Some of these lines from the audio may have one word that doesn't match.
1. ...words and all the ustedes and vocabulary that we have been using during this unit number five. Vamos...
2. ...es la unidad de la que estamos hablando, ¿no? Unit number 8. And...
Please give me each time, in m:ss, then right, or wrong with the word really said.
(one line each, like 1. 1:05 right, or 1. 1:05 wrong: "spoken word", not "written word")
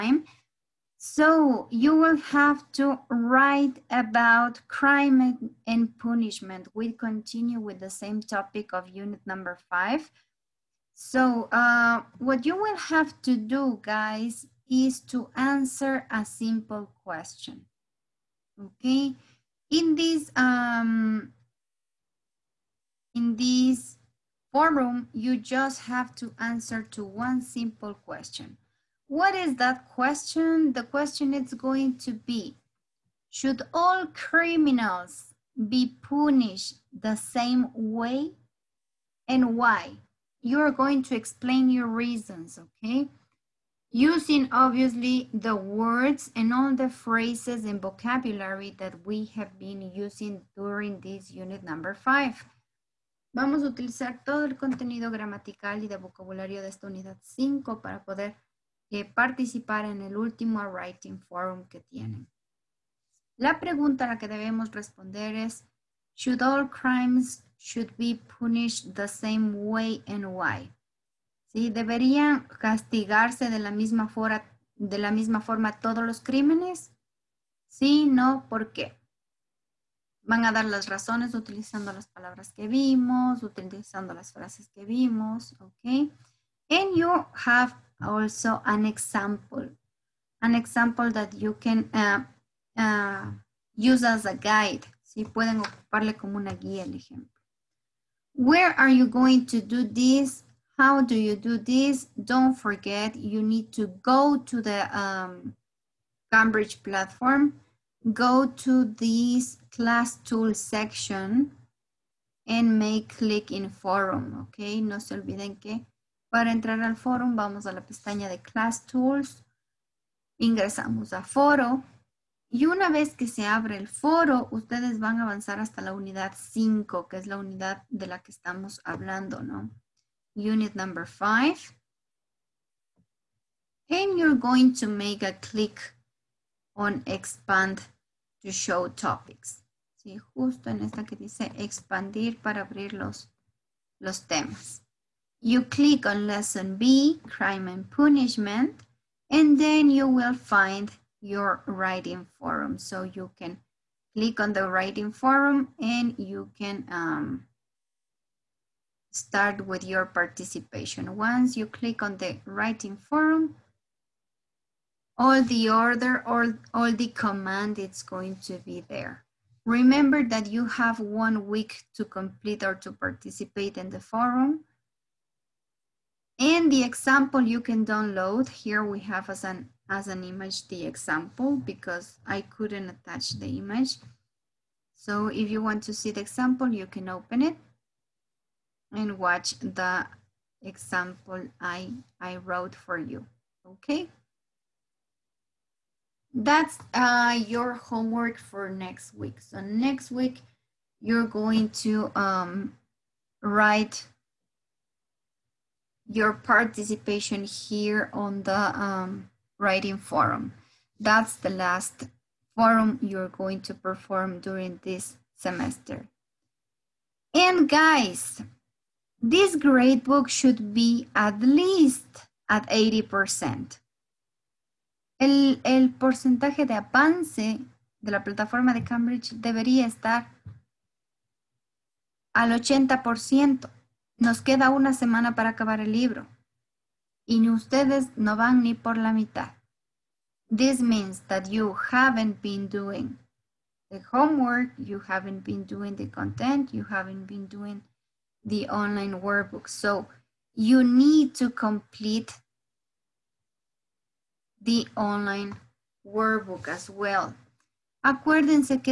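1. 0:45 wrong: "phrases", not "ustedes"
2. 2:07 wrong: "5", not "8".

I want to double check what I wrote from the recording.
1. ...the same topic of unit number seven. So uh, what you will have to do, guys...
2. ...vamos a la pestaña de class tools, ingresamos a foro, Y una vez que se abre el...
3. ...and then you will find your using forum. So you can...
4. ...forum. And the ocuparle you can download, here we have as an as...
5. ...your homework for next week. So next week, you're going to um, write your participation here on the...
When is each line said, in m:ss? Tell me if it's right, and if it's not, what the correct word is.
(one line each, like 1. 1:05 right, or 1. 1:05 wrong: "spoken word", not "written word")
1. 0:07 wrong: "five", not "seven"
2. 1:57 right
3. 2:29 wrong: "writing", not "using"
4. 2:53 wrong: "example", not "ocuparle"
5. 3:17 right.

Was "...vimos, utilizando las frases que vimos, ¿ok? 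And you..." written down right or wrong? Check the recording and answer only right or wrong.
right.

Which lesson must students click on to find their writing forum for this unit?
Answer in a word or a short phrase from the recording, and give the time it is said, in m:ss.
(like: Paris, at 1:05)
lesson B, at 2:26.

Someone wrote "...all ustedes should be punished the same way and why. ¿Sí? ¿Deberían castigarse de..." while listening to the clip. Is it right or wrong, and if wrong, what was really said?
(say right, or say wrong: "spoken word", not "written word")
wrong: "crimes", not "ustedes".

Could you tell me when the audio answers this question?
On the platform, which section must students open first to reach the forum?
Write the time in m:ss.
1:49.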